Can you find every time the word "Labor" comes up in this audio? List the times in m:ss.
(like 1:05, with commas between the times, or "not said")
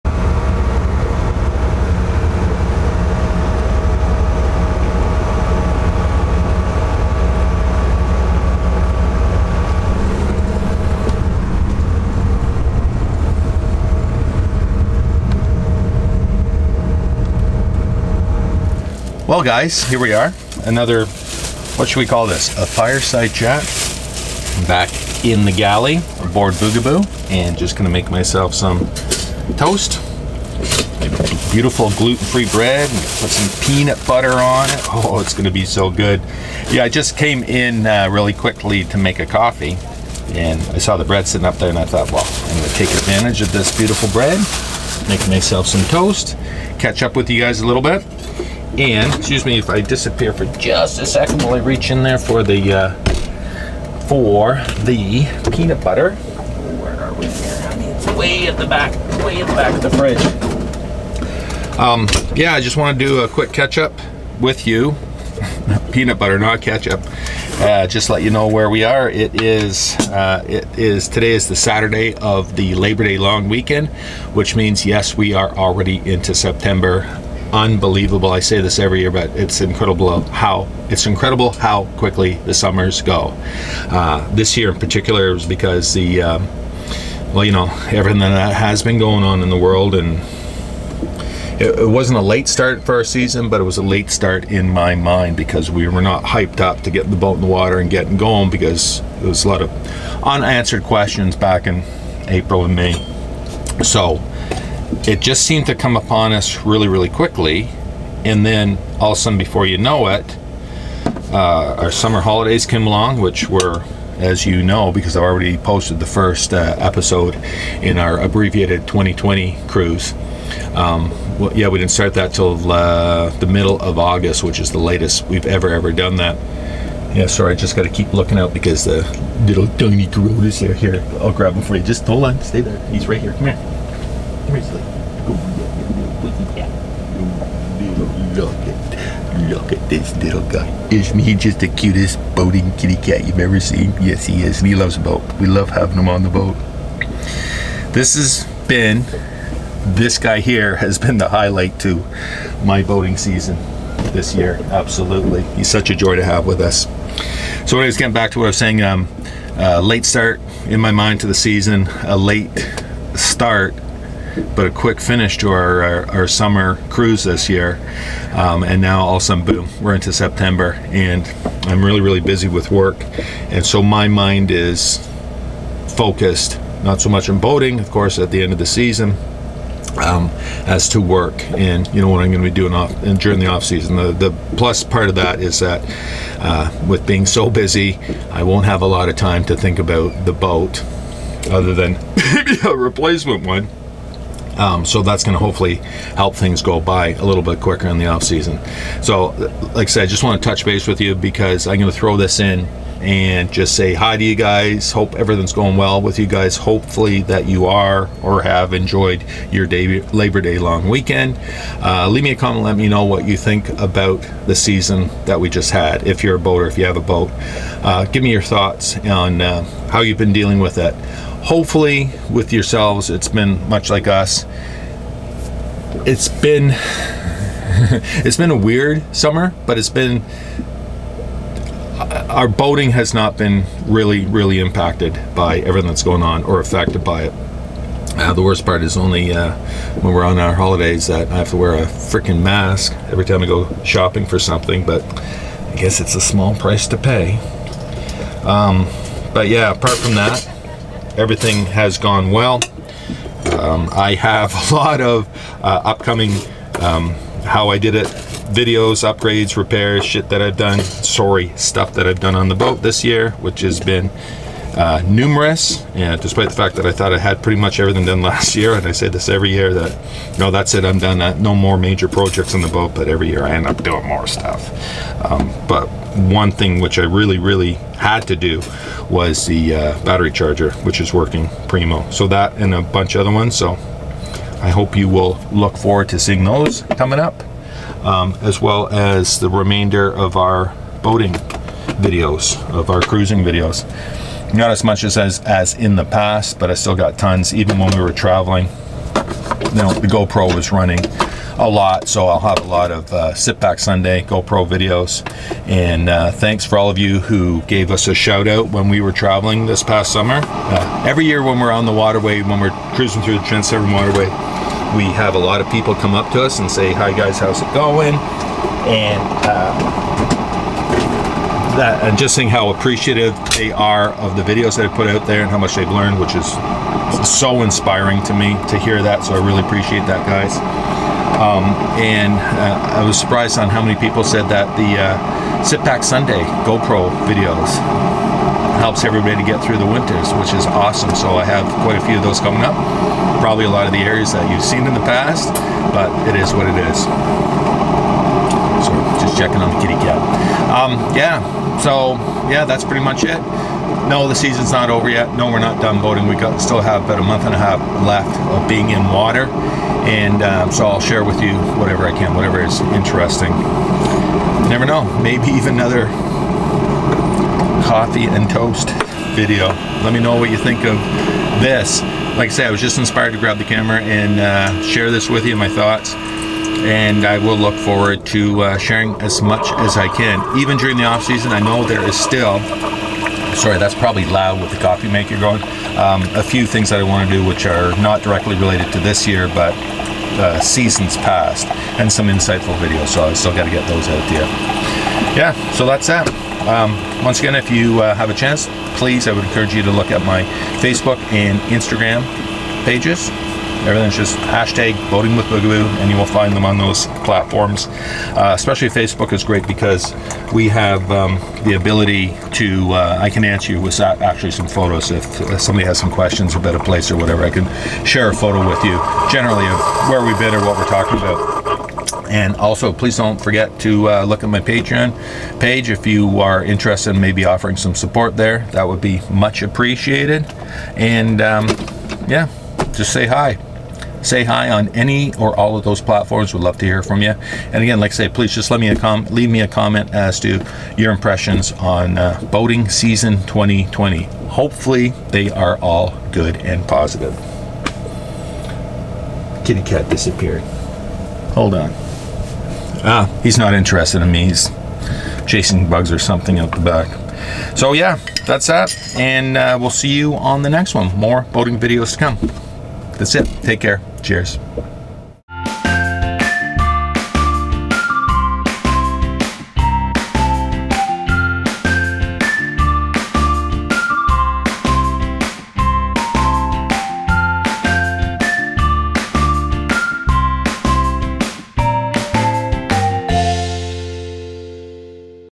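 1:12, 3:30.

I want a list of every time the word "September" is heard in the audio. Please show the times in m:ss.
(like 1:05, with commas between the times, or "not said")
1:16, 2:50.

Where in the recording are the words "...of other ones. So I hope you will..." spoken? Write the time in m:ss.
4:43.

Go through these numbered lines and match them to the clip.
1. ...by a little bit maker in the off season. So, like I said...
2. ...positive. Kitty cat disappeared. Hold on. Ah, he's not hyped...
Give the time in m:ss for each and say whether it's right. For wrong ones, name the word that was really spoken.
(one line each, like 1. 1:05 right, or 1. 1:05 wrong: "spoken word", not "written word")
1. 3:16 wrong: "quicker", not "maker"
2. 7:26 wrong: "interested", not "hyped".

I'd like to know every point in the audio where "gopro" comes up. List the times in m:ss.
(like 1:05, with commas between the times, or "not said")
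5:00, 5:04, 5:36.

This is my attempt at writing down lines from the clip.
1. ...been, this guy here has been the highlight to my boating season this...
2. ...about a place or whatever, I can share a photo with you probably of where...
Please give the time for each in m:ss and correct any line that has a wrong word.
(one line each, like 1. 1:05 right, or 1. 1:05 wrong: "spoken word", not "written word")
1. 2:28 right
2. 6:56 wrong: "generally", not "probably".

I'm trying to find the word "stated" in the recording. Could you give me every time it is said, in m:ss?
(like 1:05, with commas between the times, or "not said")
not said.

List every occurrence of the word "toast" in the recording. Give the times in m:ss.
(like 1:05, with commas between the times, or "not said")
0:29, 0:45, 6:08.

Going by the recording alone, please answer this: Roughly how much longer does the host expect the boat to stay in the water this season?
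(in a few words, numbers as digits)
a month and a half.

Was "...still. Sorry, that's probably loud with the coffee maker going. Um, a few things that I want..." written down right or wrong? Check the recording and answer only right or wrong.
right.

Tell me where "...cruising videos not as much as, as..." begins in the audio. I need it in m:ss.
4:53.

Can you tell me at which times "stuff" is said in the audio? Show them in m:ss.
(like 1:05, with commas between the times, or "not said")
4:21, 4:34.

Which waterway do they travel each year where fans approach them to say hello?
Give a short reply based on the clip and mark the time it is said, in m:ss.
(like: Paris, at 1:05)
Trent Severn waterway, at 5:13.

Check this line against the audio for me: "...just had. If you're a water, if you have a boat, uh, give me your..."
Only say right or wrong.
wrong.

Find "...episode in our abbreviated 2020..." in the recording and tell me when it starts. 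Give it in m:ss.
1:56.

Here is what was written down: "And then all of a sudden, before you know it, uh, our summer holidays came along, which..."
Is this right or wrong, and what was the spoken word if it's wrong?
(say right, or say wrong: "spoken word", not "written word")
right.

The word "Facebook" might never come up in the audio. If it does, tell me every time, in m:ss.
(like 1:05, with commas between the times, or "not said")
6:40, 6:48.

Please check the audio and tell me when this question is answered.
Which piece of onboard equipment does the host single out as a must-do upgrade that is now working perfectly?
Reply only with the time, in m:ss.
4:40.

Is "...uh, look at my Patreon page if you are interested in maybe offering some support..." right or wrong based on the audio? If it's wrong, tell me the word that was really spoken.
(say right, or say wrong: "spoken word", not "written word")
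right.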